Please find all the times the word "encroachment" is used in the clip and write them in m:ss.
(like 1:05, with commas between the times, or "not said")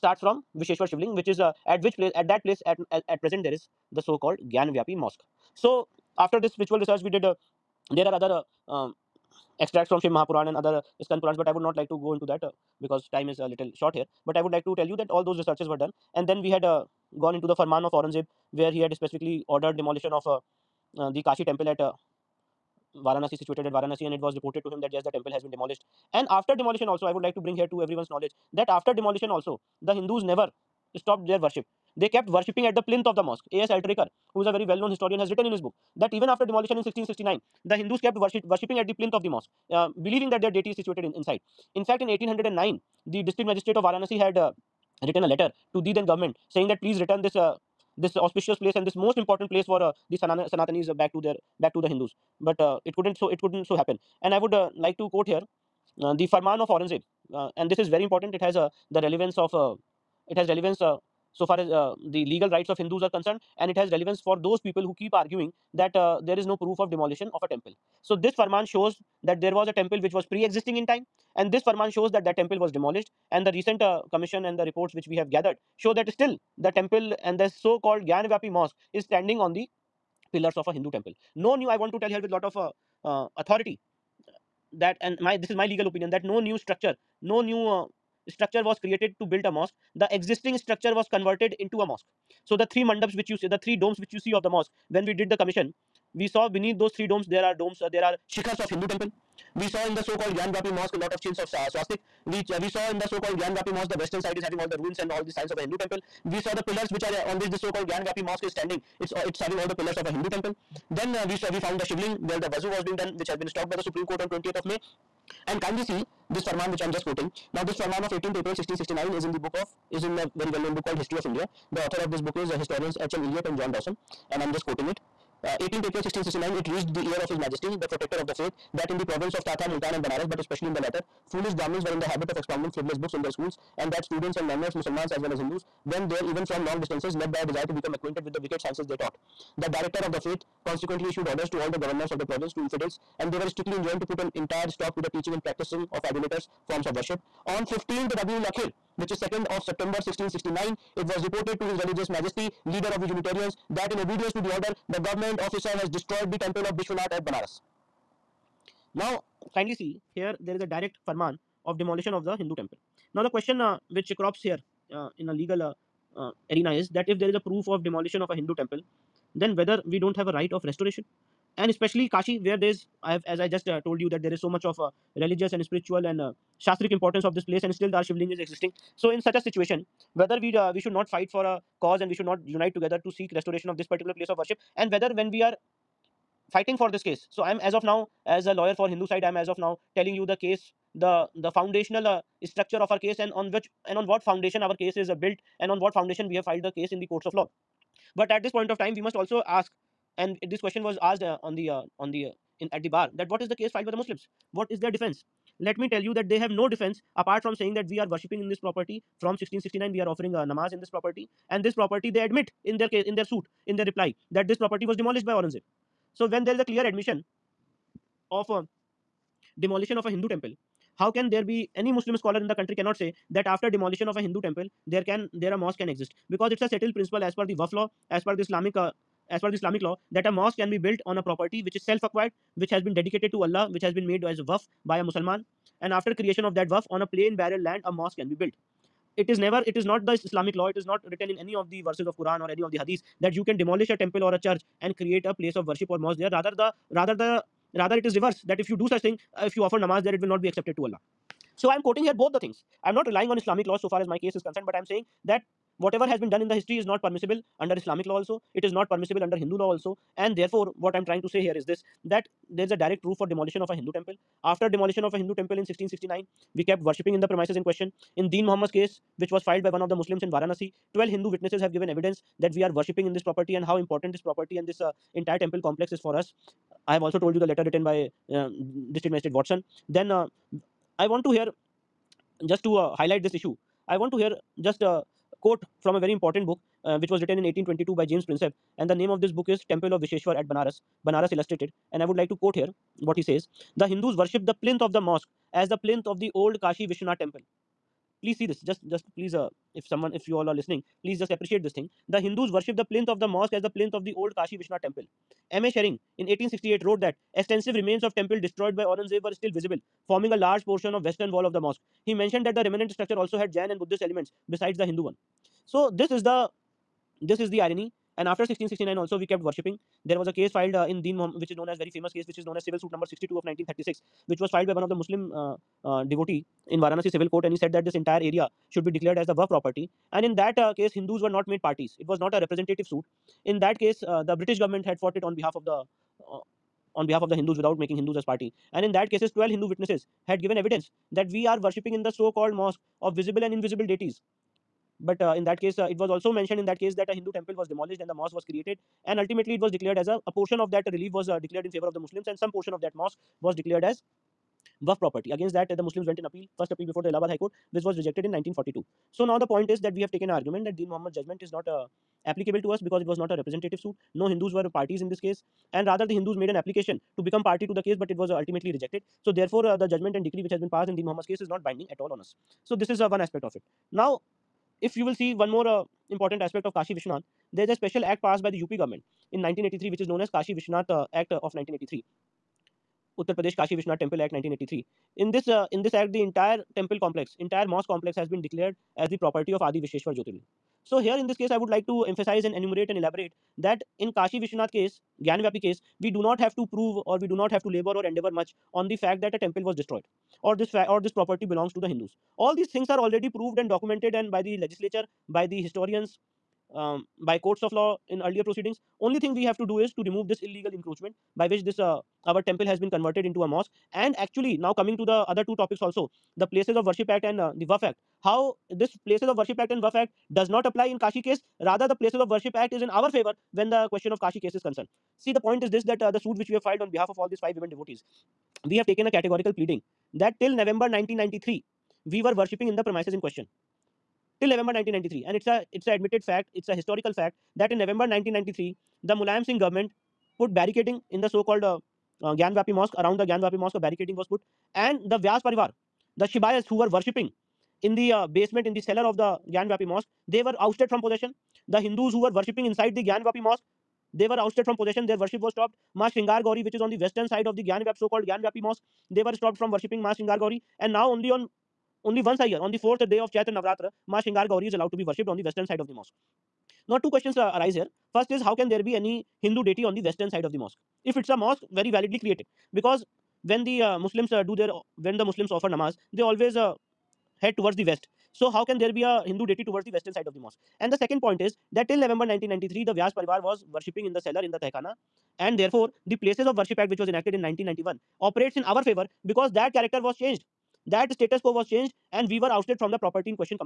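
6:50.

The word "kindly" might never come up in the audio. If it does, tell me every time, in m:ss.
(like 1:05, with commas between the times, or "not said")
1:55, 2:39.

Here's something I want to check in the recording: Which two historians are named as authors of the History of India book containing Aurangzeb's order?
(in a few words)
H. M. Elliot and John Dowson.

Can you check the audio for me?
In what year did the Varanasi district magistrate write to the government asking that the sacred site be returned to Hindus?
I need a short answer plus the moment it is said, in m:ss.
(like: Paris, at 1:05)
1809, at 0:42.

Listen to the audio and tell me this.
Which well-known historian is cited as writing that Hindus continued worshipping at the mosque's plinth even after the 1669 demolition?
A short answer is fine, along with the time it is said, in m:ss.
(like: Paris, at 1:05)
A.S. Altekar, at 0:33.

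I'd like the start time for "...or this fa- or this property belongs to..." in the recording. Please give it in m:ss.
6:40.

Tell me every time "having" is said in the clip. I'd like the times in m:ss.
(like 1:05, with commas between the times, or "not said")
1:44, 1:49.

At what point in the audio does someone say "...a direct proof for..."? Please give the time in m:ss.
4:22.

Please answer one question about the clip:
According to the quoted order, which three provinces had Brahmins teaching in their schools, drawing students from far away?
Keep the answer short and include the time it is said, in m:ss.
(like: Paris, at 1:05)
Thatta, Multan and Banaras, at 2:09.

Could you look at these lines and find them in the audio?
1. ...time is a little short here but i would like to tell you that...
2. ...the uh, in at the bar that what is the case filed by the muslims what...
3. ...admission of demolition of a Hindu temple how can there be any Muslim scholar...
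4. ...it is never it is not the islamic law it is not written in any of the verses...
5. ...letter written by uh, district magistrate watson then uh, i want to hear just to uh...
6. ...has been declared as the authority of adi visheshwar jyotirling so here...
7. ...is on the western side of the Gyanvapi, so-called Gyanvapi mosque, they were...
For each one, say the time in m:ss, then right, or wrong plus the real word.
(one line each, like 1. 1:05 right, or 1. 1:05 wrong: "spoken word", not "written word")
1. 0:13 right
2. 3:22 right
3. 3:36 right
4. 3:59 right
5. 4:37 right
6. 6:28 wrong: "property", not "authority"
7. 7:36 right.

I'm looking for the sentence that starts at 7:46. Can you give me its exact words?
Now, two questions uh, arise here.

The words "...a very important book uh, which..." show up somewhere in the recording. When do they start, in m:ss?
4:45.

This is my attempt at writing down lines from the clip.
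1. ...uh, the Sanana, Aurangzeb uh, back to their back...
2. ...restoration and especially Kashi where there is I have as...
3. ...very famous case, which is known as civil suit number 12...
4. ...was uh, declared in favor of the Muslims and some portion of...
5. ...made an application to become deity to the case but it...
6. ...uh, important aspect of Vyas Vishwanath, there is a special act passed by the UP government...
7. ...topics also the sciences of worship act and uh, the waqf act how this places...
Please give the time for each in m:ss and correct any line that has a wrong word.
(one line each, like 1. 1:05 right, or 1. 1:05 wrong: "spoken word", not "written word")
1. 0:49 wrong: "Sanatanis", not "Aurangzeb"
2. 2:50 right
3. 5:21 wrong: "62", not "12"
4. 5:51 right
5. 6:06 wrong: "party", not "deity"
6. 6:15 wrong: "Kashi", not "Vyas"
7. 6:55 wrong: "places", not "sciences".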